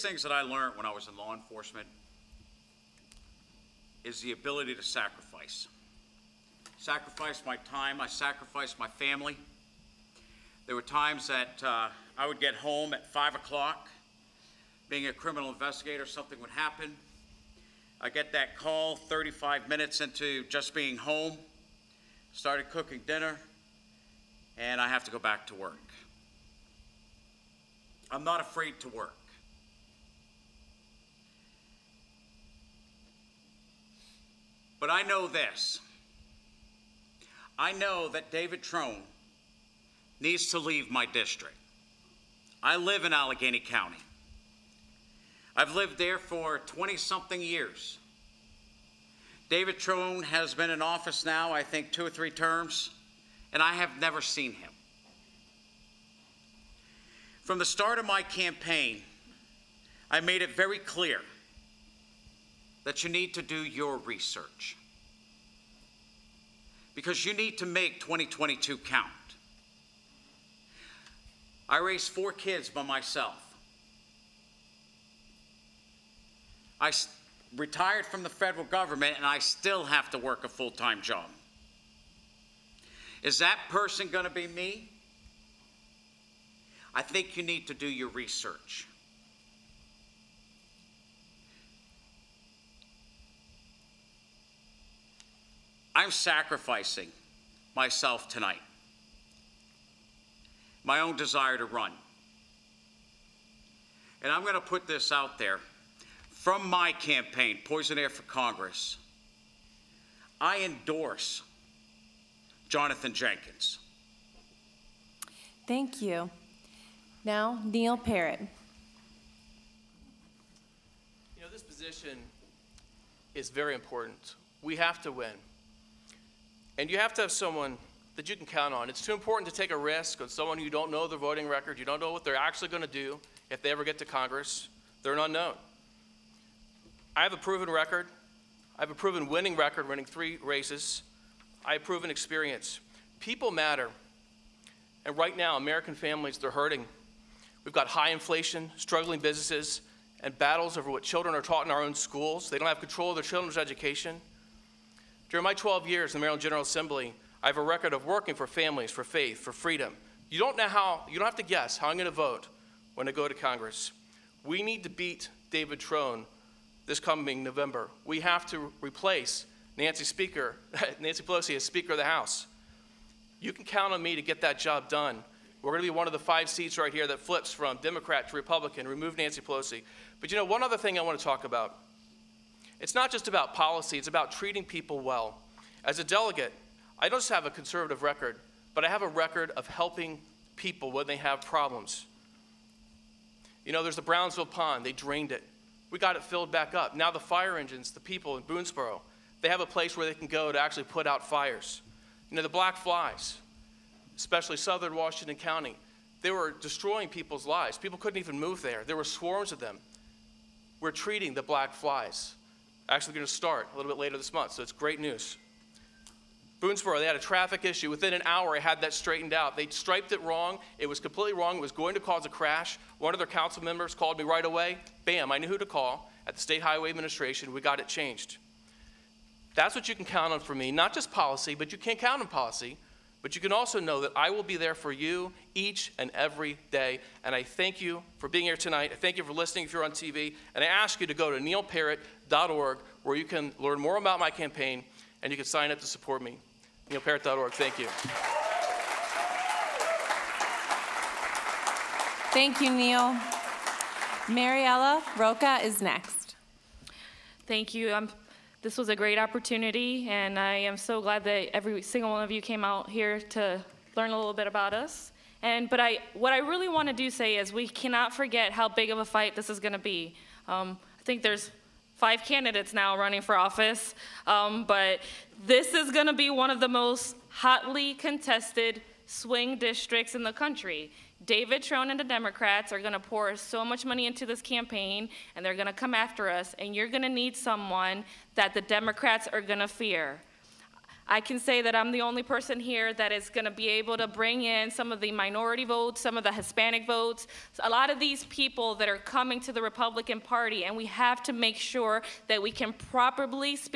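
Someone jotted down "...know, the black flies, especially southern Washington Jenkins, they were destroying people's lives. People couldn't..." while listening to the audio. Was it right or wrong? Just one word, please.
wrong.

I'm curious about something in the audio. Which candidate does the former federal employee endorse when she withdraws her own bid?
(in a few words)
Jonathan Jenkins.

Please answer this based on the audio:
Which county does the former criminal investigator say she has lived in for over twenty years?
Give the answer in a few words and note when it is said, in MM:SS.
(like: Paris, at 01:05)
Allegany County, at 00:43.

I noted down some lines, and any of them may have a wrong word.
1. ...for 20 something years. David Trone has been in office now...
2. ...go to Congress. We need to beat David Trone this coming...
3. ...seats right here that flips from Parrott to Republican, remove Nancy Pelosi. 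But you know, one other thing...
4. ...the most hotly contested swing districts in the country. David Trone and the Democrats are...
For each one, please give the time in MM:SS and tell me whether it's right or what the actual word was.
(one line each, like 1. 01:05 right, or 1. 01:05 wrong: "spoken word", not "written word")
1. 00:46 right
2. 02:43 right
3. 02:56 wrong: "Democrat", not "Parrott"
4. 04:36 right.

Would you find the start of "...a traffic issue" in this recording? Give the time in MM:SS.
03:37.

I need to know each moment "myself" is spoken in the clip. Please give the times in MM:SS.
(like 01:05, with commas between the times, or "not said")
01:12, 01:37.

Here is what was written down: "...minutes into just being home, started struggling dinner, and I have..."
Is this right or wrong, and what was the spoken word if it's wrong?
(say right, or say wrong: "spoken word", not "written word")
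wrong: "cooking", not "struggling".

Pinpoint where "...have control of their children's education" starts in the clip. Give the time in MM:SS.
02:32.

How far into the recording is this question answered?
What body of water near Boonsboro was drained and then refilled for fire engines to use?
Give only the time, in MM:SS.
03:14.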